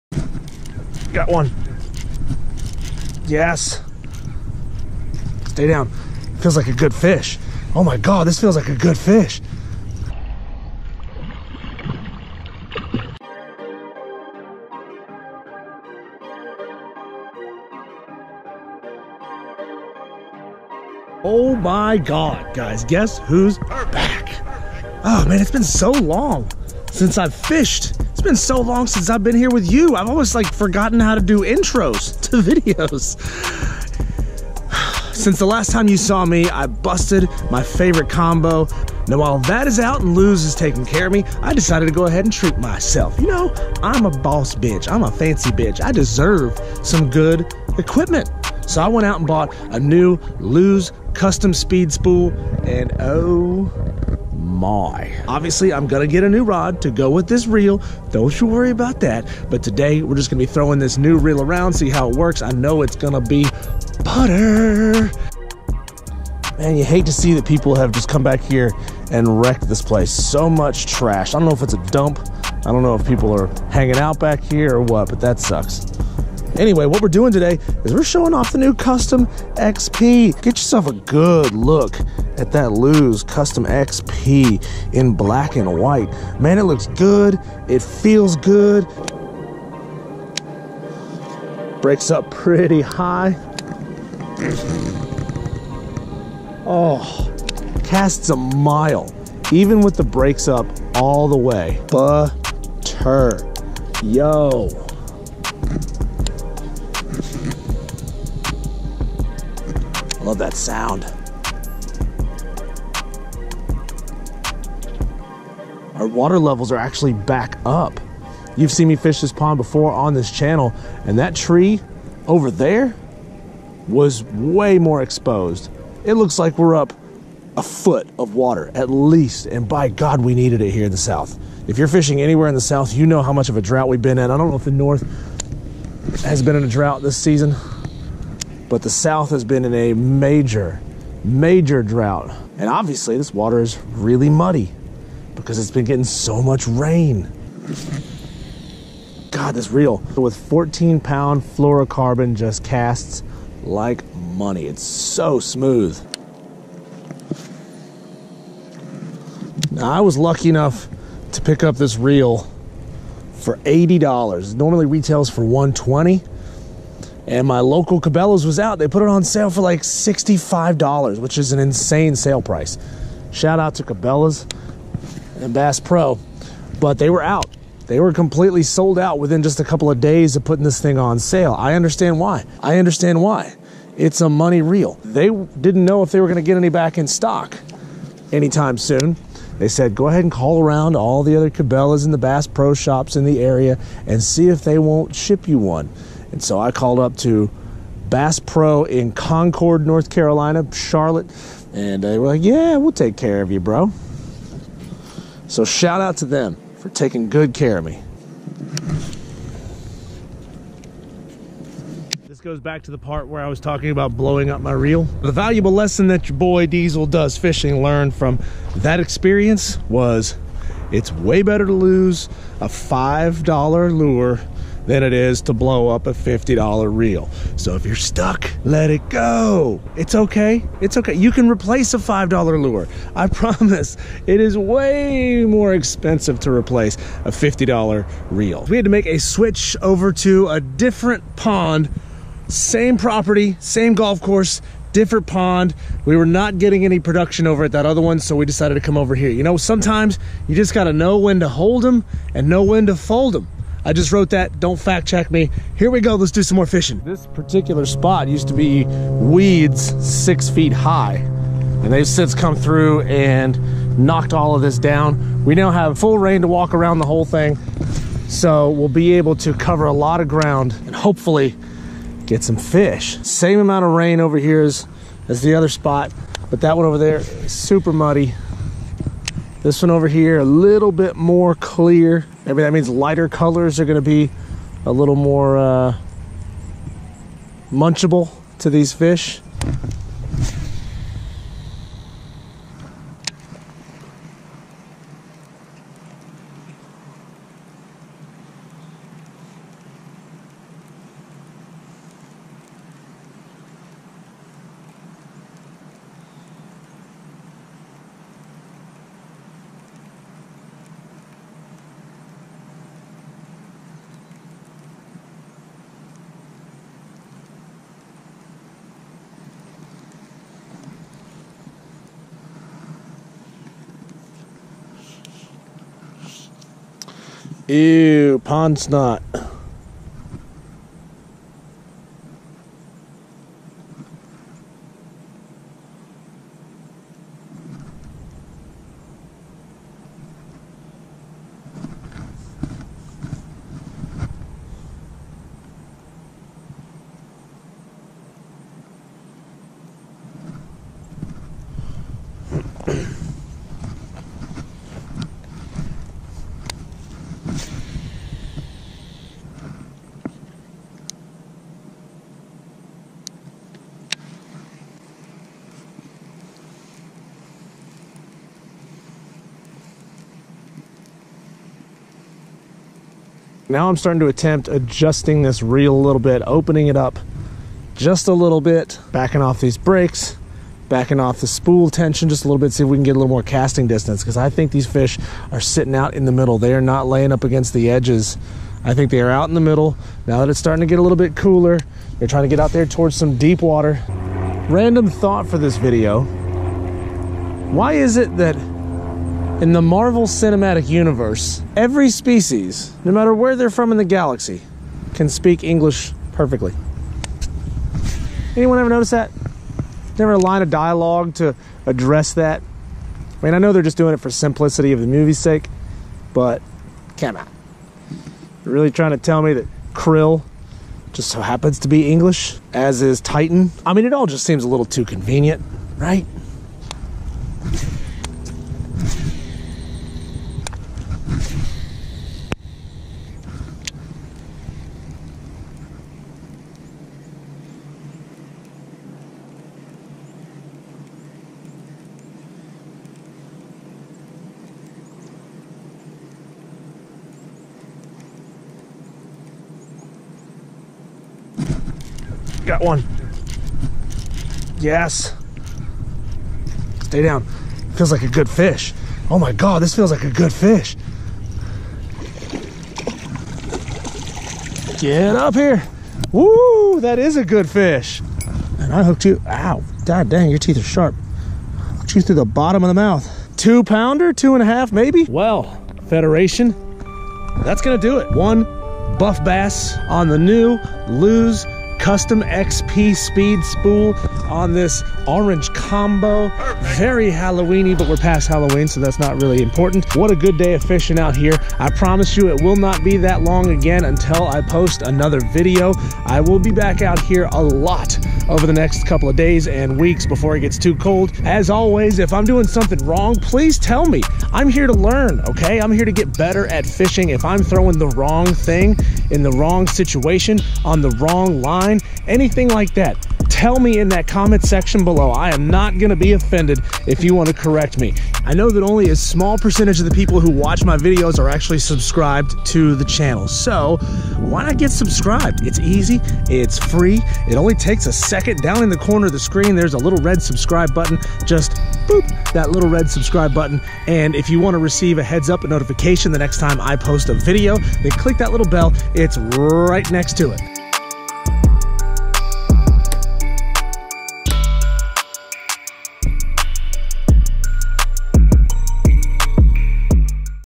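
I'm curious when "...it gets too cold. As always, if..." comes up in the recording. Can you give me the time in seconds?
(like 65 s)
500 s.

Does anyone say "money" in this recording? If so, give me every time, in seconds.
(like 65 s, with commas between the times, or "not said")
154 s, 184 s.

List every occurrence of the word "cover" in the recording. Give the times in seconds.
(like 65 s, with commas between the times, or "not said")
269 s.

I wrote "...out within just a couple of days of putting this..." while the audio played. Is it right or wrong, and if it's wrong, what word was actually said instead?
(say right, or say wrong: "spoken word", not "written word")
right.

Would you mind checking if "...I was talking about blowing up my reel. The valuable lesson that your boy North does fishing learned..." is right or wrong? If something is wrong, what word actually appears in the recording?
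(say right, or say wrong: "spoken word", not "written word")
wrong: "Diesel", not "North".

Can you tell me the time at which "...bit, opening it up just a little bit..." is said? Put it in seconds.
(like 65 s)
376 s.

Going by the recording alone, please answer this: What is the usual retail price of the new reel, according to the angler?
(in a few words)
$120.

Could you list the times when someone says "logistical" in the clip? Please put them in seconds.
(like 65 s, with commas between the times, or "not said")
not said.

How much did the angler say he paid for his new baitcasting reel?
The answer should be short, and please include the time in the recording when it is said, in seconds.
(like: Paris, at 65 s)
$80, at 163 s.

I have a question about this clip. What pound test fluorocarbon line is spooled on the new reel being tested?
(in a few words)
14 pound.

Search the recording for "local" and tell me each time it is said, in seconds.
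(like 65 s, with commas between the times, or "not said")
167 s.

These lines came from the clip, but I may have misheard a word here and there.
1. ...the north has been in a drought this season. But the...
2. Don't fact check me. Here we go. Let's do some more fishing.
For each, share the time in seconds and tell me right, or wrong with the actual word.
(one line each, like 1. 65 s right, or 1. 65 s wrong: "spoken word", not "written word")
1. 134 s right
2. 254 s right.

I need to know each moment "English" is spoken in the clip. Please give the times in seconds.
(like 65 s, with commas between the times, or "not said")
405 s, 422 s.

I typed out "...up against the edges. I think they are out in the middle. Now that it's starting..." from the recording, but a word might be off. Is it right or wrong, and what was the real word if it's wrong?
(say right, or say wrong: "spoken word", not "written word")
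right.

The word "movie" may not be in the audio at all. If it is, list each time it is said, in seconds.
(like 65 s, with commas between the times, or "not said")
415 s.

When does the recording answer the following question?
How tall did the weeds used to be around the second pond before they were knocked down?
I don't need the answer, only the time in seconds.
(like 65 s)
260 s.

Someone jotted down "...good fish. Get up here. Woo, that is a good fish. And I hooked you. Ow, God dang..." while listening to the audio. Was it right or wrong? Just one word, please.
right.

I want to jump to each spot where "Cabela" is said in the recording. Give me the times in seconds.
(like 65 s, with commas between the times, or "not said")
168 s, 173 s, 191 s.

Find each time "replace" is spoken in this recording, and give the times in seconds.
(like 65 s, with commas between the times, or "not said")
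231 s, 236 s.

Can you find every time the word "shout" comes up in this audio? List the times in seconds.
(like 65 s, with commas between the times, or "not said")
173 s, 205 s.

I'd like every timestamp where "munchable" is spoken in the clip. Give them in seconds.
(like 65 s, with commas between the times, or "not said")
287 s.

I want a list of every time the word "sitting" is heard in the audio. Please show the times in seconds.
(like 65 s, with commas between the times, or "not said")
385 s.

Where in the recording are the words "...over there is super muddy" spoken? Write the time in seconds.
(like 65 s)
276 s.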